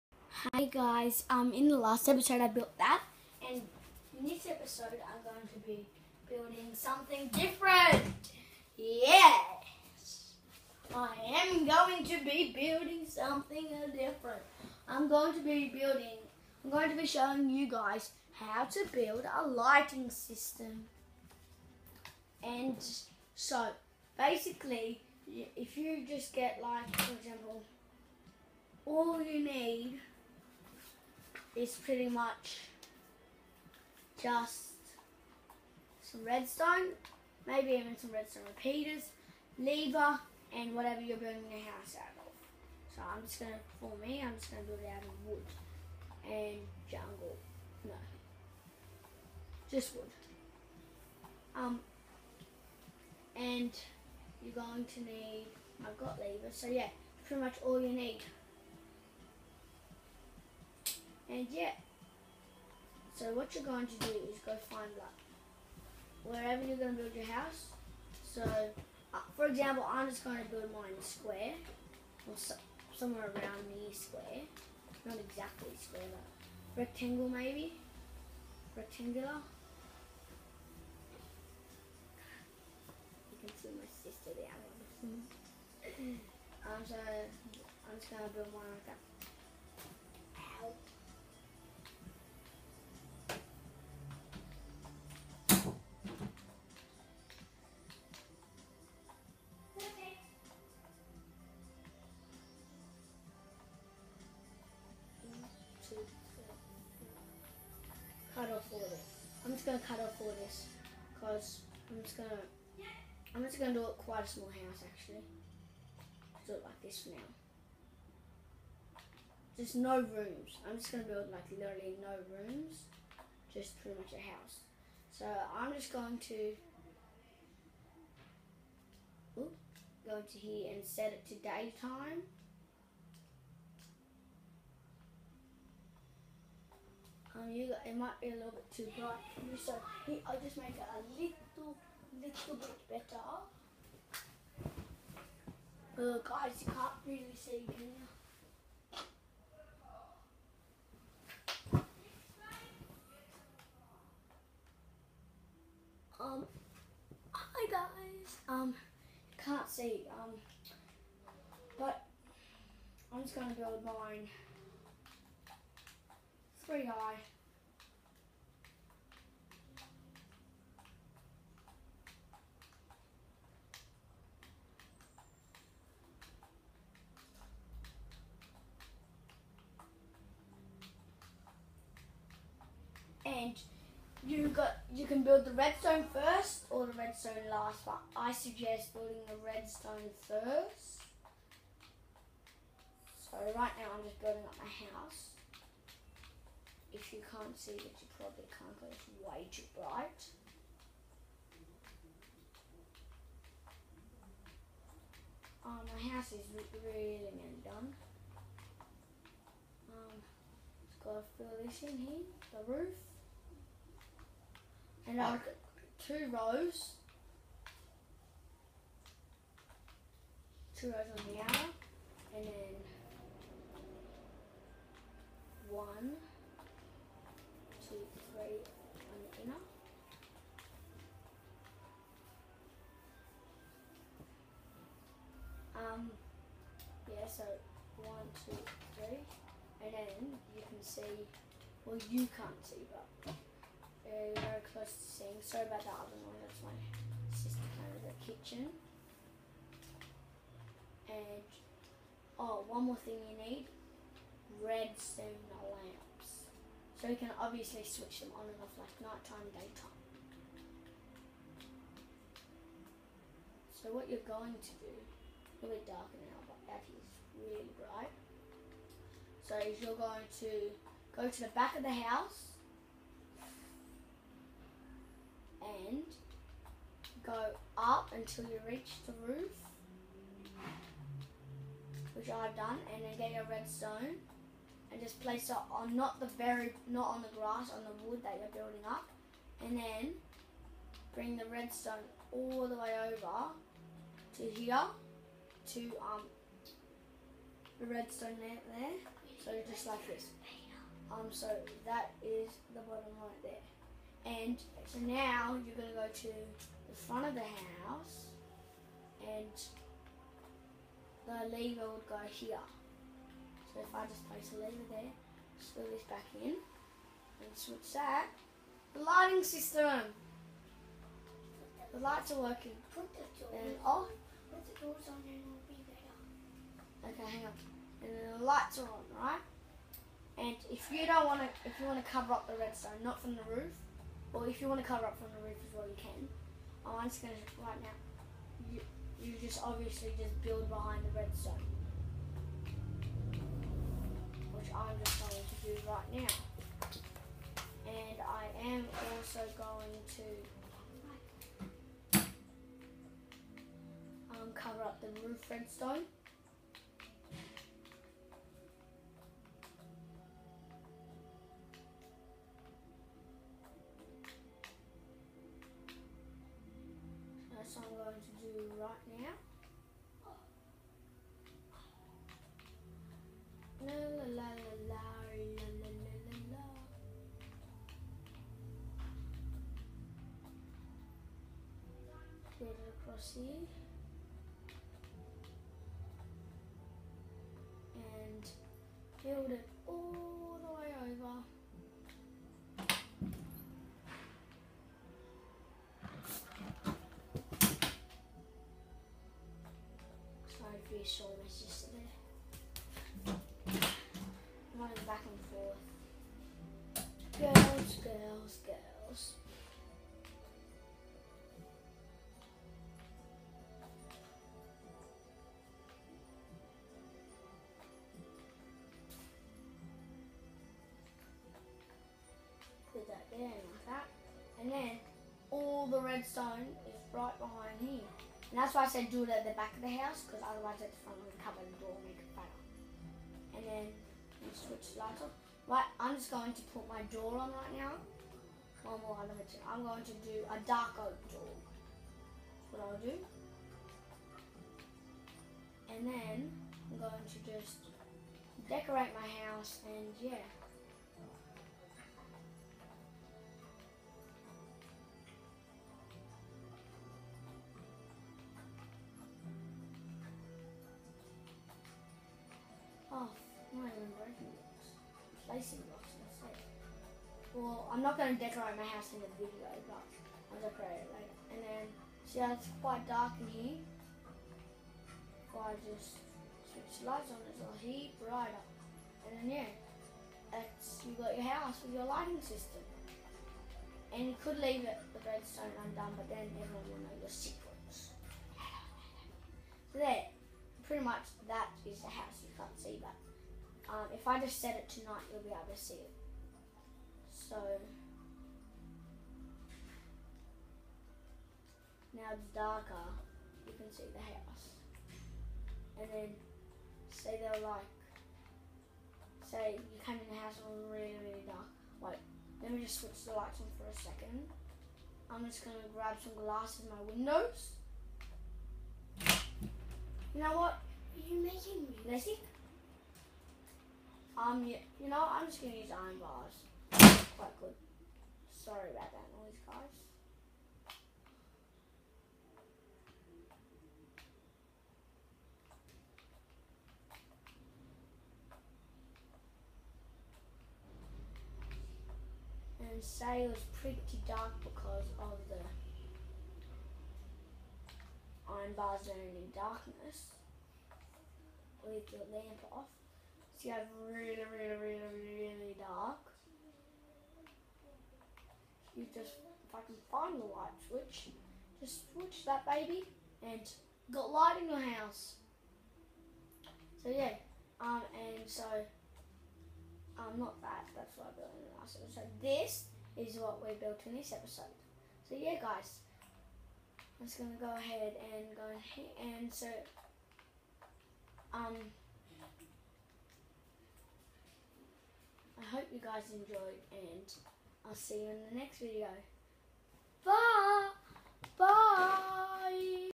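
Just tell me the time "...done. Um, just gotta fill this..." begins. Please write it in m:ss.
3:27.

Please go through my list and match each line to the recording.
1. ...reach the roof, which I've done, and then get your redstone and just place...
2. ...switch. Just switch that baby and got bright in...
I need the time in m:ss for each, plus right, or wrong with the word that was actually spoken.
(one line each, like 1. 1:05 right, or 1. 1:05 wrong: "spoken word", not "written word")
1. 4:38 right
2. 9:20 wrong: "light", not "bright".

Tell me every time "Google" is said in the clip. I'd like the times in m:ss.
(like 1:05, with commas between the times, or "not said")
not said.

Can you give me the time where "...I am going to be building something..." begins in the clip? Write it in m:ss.
0:10.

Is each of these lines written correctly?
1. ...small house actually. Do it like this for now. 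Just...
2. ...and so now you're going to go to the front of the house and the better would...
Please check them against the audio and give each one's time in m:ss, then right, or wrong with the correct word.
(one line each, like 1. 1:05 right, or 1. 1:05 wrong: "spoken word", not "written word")
1. 1:54 right
2. 5:04 wrong: "lever", not "better".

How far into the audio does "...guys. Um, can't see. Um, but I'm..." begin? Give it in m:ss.
2:37.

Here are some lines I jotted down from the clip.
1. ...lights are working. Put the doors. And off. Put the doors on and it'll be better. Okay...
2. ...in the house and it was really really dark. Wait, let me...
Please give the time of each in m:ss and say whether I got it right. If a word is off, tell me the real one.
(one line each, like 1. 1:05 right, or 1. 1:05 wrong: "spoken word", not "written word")
1. 5:21 right
2. 8:30 right.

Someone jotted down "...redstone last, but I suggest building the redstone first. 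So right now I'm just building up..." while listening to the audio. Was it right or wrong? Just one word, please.
right.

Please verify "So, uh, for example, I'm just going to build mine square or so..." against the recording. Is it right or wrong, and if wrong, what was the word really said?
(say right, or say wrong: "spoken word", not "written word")
right.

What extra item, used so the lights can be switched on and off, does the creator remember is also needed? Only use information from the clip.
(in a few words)
Redstone lamp.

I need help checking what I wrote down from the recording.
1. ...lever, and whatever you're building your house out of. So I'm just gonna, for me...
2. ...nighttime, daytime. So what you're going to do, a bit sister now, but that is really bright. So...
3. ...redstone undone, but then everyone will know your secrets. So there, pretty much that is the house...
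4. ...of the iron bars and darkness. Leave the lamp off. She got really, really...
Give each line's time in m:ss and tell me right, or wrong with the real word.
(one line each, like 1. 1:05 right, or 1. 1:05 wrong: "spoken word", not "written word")
1. 0:39 right
2. 4:19 wrong: "darker", not "sister"
3. 8:05 right
4. 9:05 right.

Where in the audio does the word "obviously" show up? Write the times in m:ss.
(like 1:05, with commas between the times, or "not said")
4:17, 5:39.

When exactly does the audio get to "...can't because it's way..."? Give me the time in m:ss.
3:18.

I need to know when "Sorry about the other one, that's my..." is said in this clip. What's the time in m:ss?
4:05.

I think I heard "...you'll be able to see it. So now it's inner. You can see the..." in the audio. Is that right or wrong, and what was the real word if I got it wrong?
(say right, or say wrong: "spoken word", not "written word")
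wrong: "darker", not "inner".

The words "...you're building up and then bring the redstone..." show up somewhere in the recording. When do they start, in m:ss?
4:48.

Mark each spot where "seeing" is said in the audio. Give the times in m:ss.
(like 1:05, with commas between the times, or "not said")
4:05.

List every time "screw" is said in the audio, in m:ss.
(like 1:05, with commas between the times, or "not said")
5:15.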